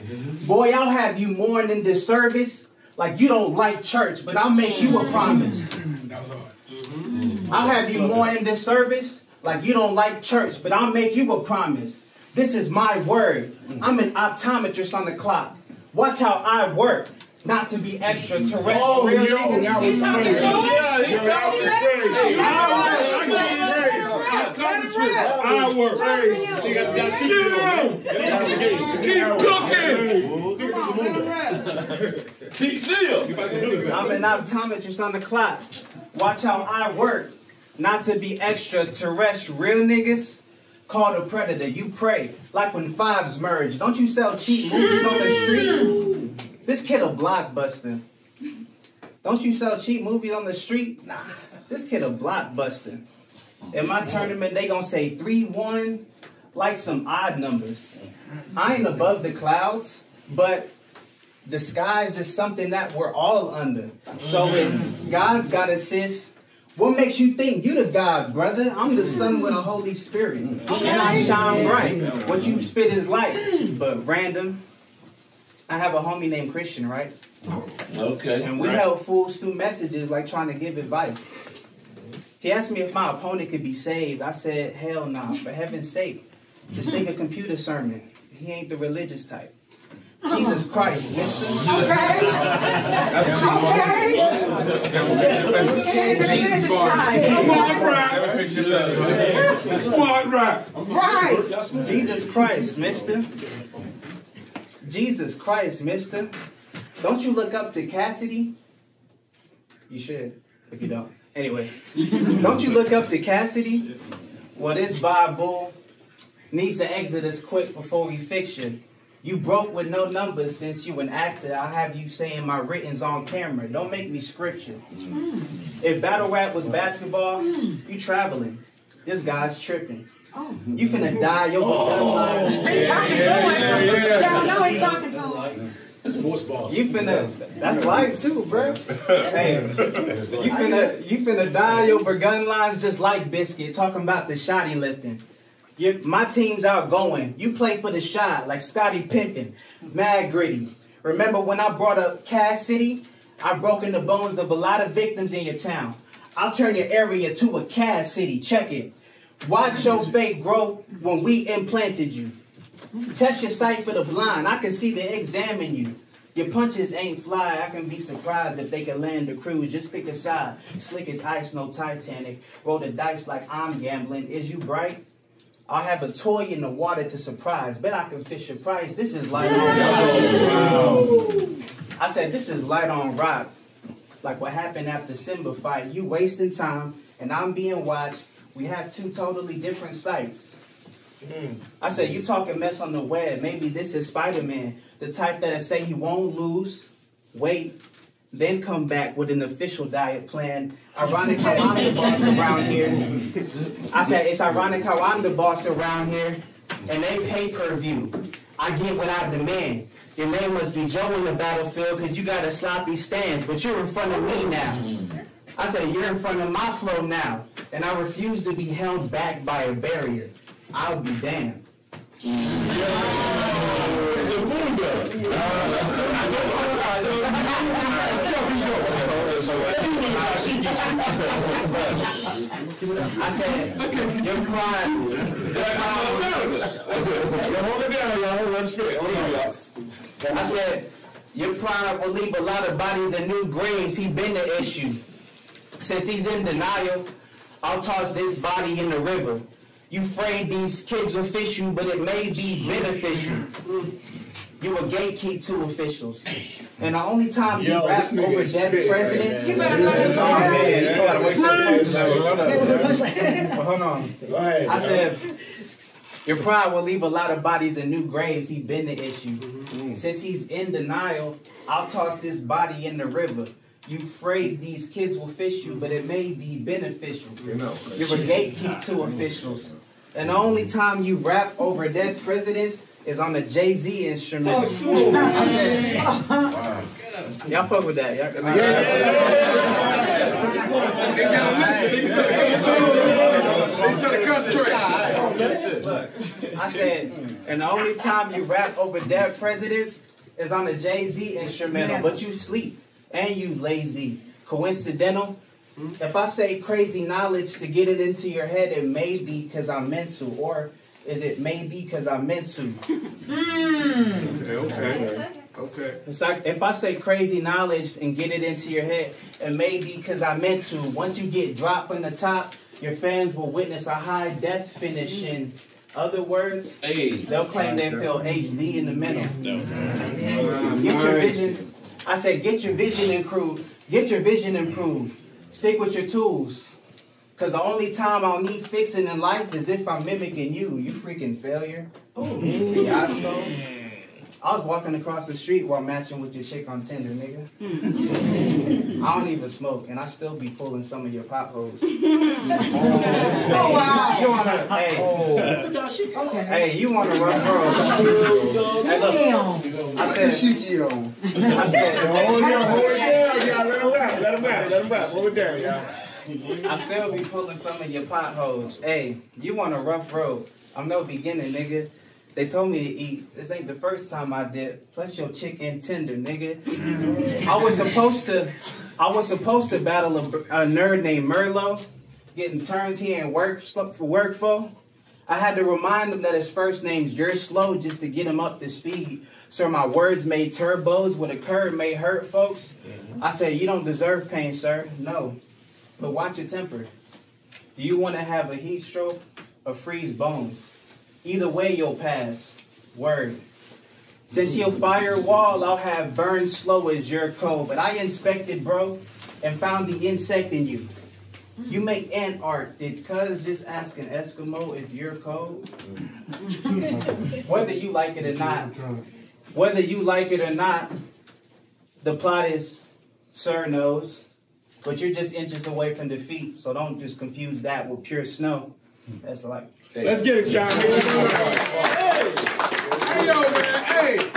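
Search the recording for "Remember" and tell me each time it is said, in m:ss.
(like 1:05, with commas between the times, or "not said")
2:31.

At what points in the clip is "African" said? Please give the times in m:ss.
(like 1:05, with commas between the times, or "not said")
not said.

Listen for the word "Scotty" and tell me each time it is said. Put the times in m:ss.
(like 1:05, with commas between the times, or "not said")
2:28.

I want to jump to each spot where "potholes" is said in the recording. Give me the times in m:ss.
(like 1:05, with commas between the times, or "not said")
5:51, 6:08.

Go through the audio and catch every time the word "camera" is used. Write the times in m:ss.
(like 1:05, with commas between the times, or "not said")
2:03.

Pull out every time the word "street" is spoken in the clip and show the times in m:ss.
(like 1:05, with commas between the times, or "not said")
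0:45, 0:50, 5:45.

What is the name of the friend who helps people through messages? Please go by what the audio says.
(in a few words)
Christian.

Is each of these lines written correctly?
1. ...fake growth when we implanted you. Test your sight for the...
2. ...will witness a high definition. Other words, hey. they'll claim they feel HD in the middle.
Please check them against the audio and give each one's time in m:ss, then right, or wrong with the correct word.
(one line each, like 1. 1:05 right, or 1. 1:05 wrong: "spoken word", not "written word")
1. 2:40 right
2. 5:23 right.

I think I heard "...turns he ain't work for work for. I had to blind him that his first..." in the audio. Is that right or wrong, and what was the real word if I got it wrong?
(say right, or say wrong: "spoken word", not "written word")
wrong: "remind", not "blind".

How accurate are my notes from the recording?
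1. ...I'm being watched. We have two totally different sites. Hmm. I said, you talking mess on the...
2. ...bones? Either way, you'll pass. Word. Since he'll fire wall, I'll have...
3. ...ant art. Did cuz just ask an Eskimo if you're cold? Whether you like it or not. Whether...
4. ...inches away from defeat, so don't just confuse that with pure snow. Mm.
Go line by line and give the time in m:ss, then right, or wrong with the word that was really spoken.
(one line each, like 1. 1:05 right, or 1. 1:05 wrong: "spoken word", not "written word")
1. 3:07 right
2. 6:40 right
3. 6:52 right
4. 7:05 right.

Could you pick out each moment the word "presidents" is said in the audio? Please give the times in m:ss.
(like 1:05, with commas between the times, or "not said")
4:18, 4:42, 4:59.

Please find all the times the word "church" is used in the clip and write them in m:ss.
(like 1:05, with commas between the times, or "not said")
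0:03, 0:10.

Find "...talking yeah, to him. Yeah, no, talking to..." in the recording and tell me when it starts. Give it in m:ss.
2:12.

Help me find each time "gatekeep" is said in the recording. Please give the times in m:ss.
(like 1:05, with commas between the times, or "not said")
4:14, 4:38.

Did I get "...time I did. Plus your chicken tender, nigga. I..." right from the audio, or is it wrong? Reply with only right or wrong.
right.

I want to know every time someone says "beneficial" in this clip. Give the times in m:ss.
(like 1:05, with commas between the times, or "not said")
4:12, 4:36.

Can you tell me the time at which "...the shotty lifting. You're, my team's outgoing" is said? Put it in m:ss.
2:24.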